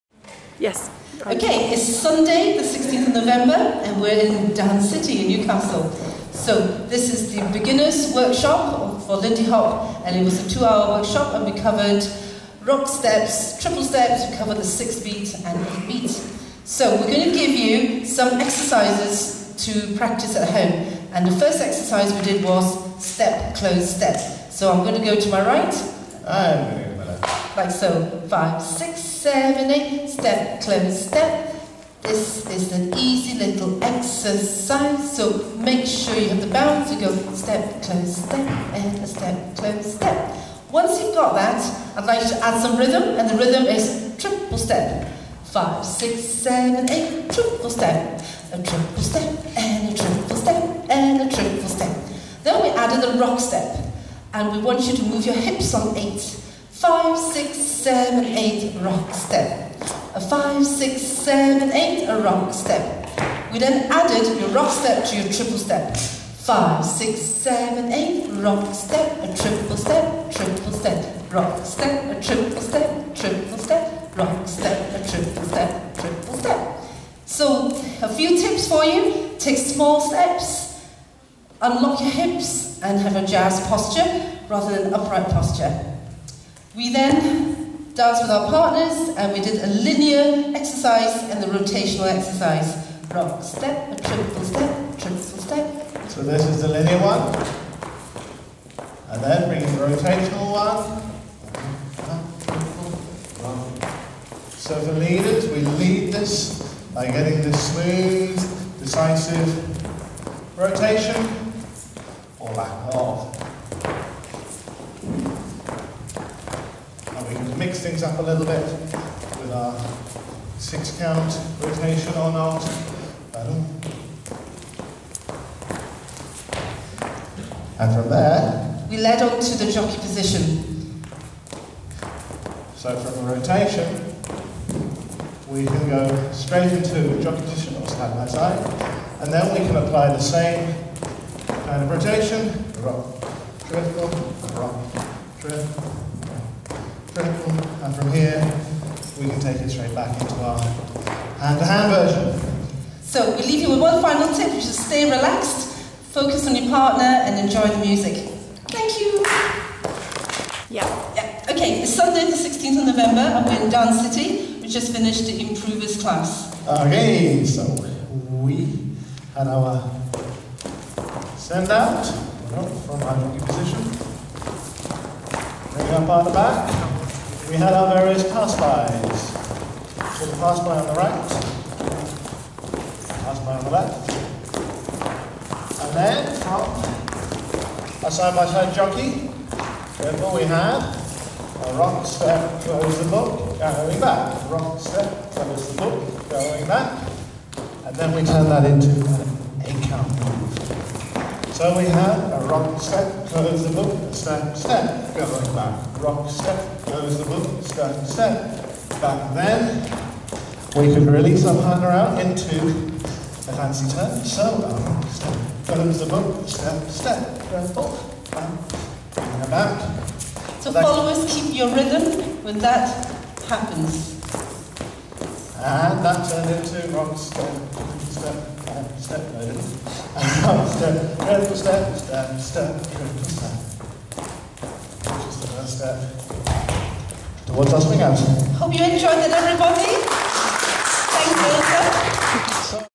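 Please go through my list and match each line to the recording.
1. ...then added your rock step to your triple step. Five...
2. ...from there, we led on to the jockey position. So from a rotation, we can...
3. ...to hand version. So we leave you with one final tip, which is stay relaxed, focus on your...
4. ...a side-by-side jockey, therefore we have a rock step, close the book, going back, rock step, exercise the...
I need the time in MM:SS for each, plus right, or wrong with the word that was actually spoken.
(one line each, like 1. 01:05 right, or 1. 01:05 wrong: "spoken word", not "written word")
1. 01:03 right
2. 02:07 right
3. 02:31 right
4. 03:08 wrong: "close", not "exercise".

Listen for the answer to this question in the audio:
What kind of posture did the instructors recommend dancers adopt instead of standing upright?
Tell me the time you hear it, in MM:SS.
01:23.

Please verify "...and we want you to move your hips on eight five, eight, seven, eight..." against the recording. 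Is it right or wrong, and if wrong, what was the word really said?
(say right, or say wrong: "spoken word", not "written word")
wrong: "six", not "eight".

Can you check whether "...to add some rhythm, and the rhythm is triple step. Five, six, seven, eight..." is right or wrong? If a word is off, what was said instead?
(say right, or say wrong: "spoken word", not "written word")
right.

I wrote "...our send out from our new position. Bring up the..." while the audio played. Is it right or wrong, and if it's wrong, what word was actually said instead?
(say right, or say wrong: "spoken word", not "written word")
right.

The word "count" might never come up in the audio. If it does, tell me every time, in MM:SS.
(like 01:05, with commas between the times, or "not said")
02:00, 03:19.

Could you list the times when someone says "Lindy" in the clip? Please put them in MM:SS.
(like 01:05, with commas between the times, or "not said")
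00:09.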